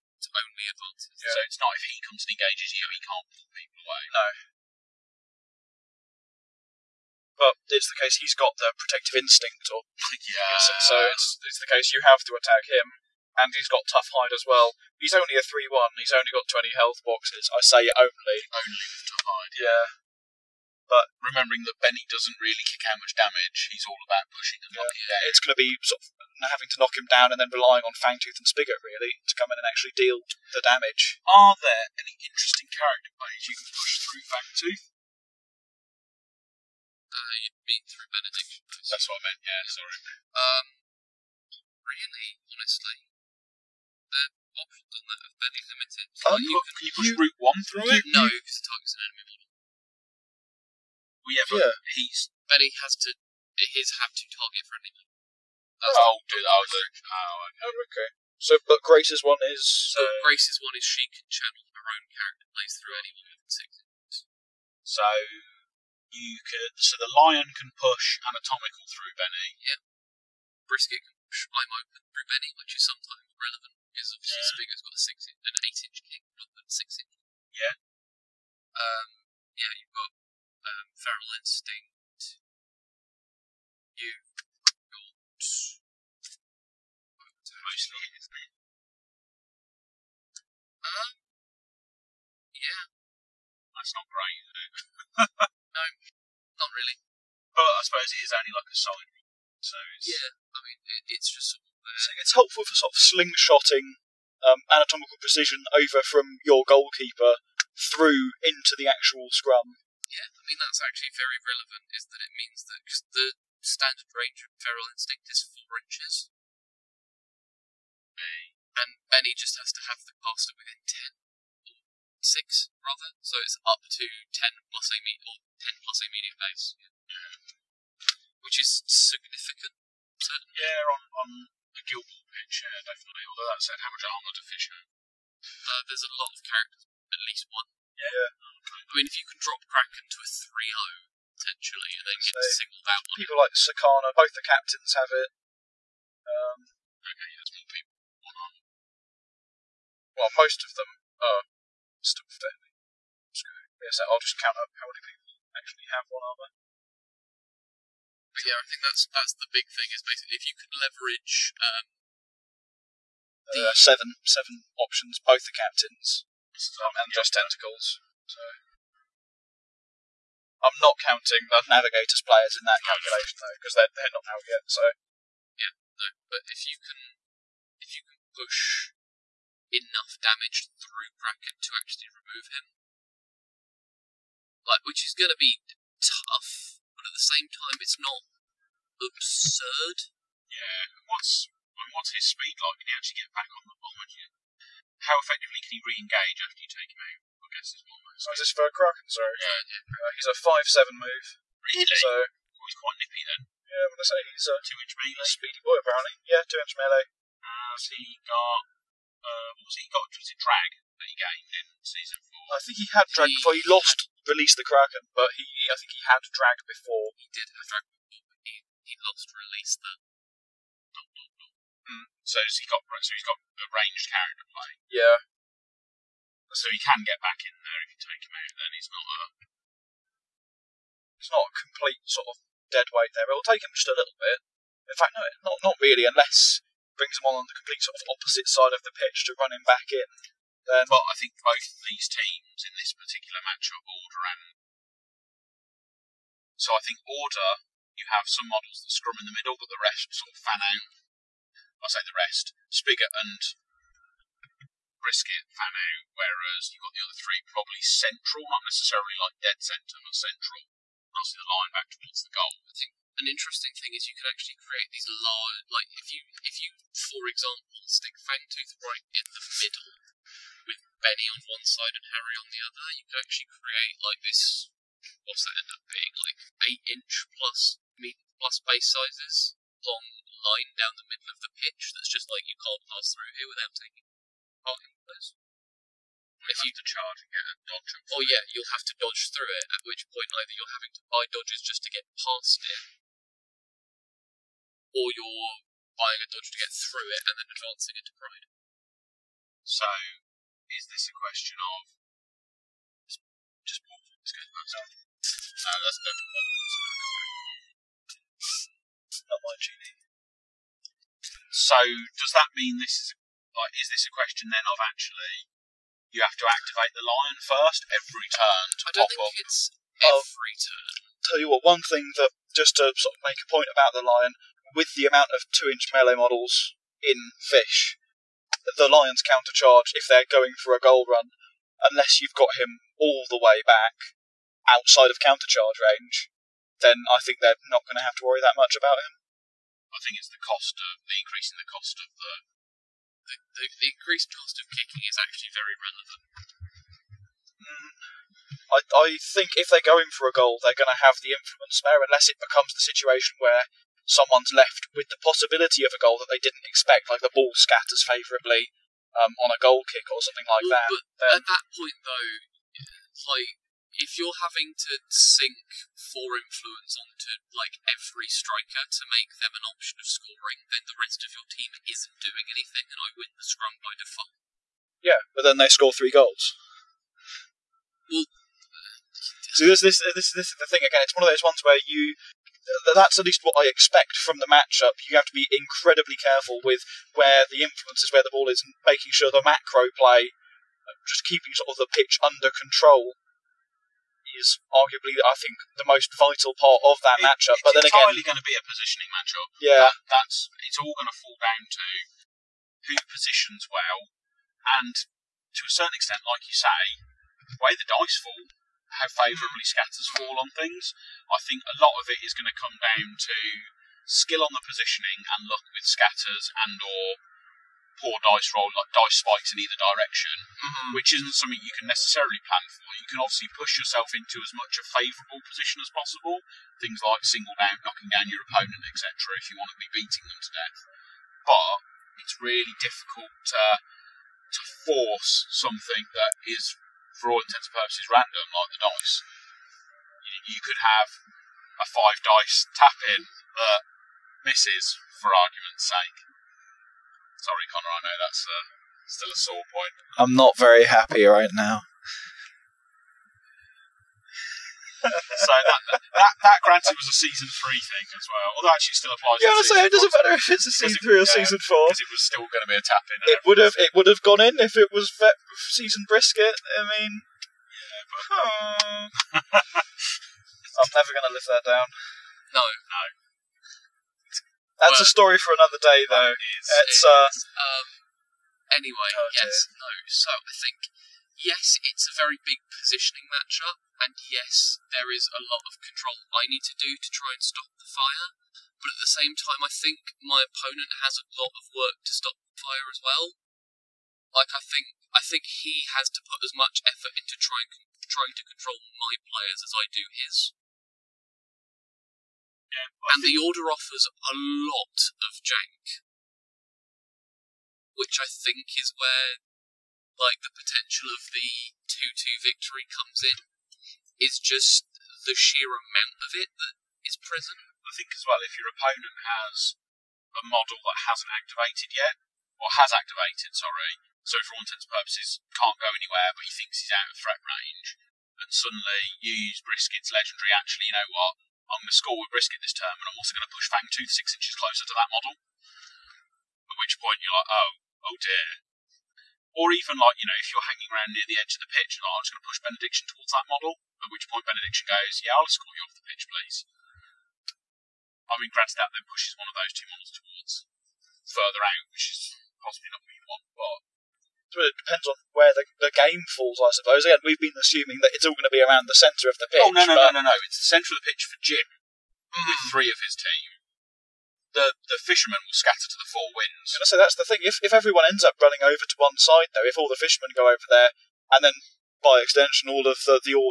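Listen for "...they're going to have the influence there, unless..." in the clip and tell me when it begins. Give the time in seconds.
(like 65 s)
350 s.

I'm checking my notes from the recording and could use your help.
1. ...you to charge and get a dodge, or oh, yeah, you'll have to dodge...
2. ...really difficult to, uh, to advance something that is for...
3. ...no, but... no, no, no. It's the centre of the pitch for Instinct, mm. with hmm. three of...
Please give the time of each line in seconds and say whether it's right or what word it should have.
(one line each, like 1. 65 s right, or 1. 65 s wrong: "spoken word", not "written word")
1. 286 s right
2. 432 s wrong: "force", not "advance"
3. 559 s wrong: "Jim", not "Instinct".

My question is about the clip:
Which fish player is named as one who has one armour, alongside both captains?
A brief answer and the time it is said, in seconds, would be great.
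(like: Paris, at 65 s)
Sakana, at 143 s.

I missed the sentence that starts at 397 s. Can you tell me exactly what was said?
But then again, it's going to be a positioning matchup.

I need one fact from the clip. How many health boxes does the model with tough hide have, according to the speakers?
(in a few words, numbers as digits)
20.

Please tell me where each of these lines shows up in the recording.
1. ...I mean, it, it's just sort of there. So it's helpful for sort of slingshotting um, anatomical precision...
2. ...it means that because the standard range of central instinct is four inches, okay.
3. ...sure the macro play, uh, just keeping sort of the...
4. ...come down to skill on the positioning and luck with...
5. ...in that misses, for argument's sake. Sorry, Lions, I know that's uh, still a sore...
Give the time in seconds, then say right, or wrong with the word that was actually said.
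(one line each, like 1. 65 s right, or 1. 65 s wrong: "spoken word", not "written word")
1. 100 s right
2. 112 s wrong: "feral", not "central"
3. 389 s right
4. 412 s right
5. 443 s wrong: "Connor", not "Lions".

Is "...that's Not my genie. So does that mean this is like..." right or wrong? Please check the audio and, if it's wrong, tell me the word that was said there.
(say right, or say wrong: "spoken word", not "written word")
right.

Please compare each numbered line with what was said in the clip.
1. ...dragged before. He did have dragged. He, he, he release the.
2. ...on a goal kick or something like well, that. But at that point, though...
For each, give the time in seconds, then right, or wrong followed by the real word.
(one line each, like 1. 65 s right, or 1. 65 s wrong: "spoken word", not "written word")
1. 216 s right
2. 359 s right.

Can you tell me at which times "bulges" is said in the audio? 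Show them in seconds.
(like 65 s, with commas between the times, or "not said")
not said.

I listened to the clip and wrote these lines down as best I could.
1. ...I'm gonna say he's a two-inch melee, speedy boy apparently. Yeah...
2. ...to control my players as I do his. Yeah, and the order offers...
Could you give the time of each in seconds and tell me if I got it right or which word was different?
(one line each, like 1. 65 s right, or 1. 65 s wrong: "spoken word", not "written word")
1. 203 s right
2. 498 s right.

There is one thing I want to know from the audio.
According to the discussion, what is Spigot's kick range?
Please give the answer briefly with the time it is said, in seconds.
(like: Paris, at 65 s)
8 inches, at 75 s.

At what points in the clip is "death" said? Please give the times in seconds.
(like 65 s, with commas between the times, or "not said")
430 s.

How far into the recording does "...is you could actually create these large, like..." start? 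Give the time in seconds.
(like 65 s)
263 s.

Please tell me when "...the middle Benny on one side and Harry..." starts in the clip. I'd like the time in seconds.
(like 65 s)
269 s.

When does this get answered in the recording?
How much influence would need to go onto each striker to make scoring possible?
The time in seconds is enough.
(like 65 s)
366 s.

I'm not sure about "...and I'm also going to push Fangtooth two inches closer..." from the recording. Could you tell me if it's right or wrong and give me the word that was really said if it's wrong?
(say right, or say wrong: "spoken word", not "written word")
wrong: "six", not "two".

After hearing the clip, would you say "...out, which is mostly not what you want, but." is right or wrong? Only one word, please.
wrong.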